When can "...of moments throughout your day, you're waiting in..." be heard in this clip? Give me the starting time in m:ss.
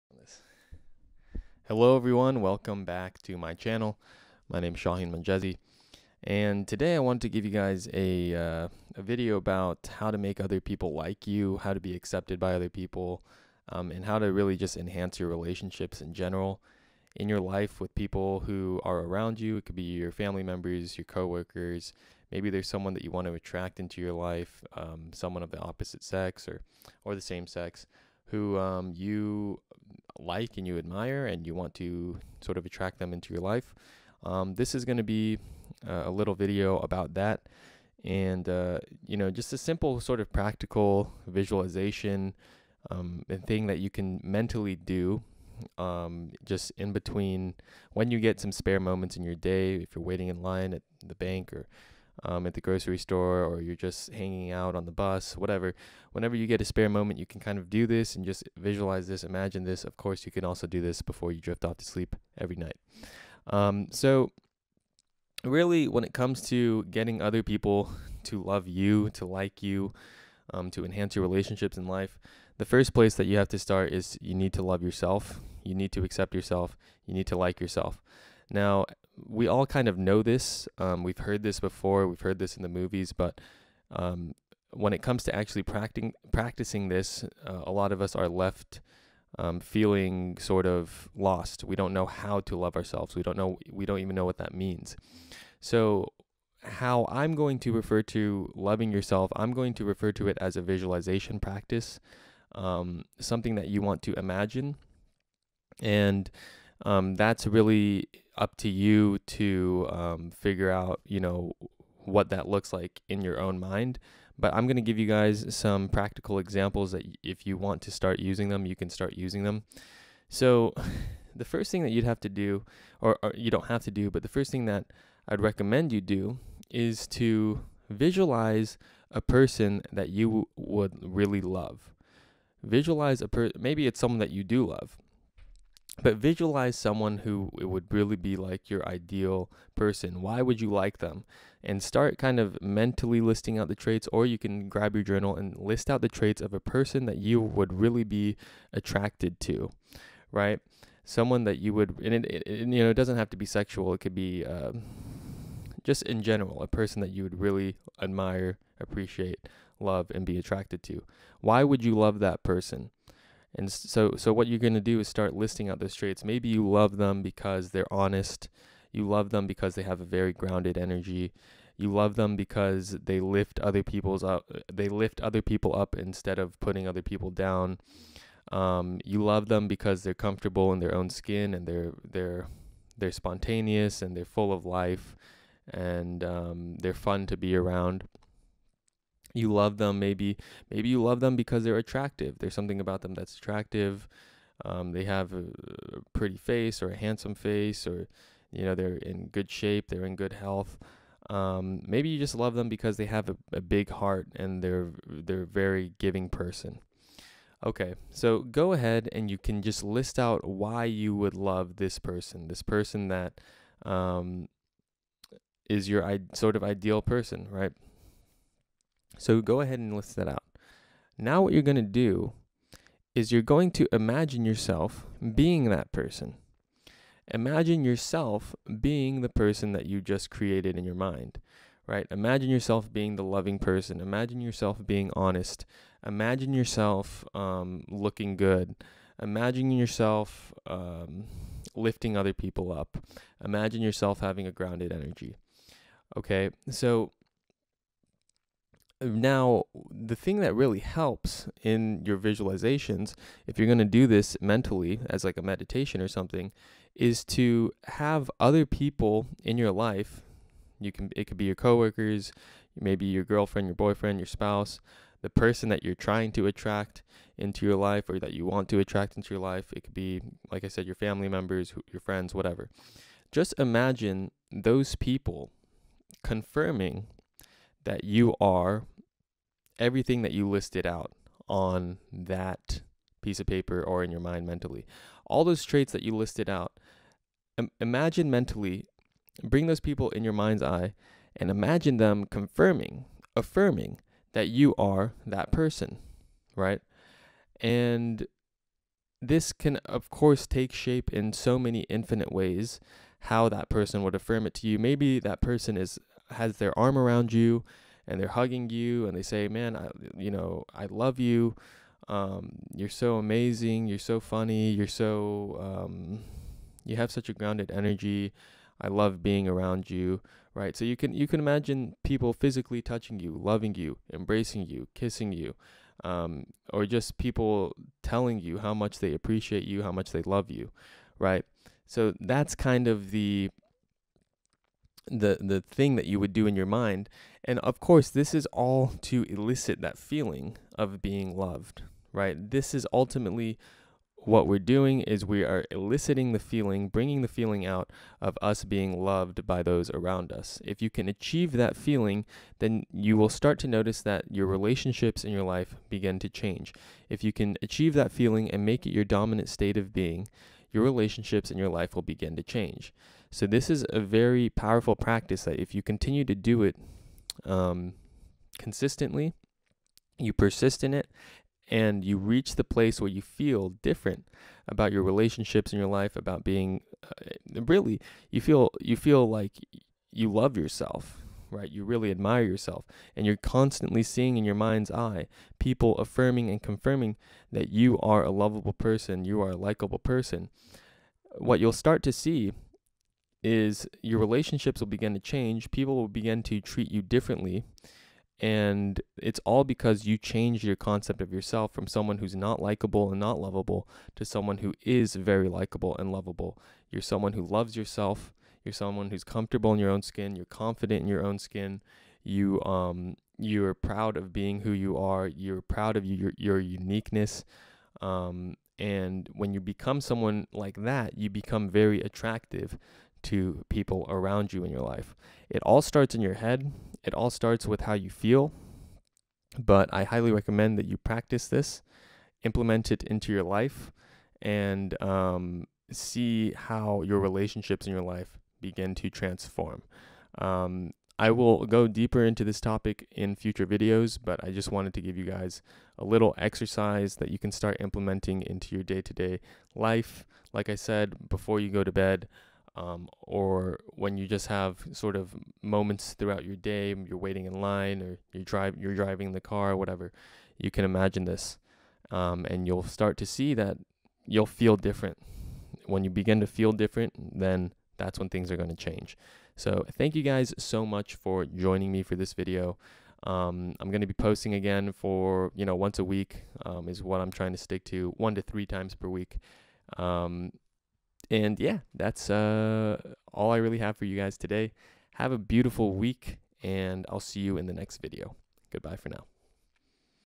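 7:35.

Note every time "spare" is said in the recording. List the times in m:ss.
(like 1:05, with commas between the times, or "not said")
0:48, 0:56.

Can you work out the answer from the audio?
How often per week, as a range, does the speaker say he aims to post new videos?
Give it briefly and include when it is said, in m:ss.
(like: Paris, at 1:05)
1 to 3 times, at 7:58.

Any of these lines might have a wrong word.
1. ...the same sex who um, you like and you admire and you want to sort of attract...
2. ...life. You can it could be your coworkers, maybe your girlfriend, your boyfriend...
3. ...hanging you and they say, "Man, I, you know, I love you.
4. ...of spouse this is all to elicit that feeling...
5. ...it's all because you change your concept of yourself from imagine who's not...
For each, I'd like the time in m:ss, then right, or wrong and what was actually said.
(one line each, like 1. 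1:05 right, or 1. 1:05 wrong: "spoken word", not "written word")
1. 0:27 right
2. 4:19 right
3. 5:08 wrong: "hugging", not "hanging"
4. 5:37 wrong: "course", not "spouse"
5. 6:39 wrong: "someone", not "imagine".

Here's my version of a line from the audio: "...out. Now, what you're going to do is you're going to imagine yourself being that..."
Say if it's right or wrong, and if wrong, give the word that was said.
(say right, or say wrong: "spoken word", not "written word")
right.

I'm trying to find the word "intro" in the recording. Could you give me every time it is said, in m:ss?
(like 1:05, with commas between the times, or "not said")
not said.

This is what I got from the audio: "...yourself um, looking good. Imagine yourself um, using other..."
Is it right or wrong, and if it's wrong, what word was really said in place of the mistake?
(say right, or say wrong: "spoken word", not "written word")
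wrong: "lifting", not "using".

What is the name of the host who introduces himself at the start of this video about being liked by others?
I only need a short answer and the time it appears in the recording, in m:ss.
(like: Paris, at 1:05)
Shahin Monjezi, at 0:04.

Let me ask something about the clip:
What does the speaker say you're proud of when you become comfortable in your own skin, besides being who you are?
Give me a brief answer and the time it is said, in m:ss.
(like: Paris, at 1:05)
your uniqueness, at 6:56.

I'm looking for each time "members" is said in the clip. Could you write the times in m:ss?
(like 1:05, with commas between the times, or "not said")
0:20, 4:31.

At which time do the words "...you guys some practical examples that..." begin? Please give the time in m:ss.
1:54.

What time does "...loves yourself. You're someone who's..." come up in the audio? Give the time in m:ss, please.
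6:47.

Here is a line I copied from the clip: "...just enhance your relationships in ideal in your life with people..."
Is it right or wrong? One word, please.
wrong.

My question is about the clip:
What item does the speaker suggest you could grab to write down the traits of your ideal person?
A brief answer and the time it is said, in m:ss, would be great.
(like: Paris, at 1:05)
journal, at 2:25.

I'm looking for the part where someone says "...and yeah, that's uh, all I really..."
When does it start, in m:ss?
8:01.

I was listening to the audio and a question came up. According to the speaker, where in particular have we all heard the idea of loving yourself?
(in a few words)
in the movies.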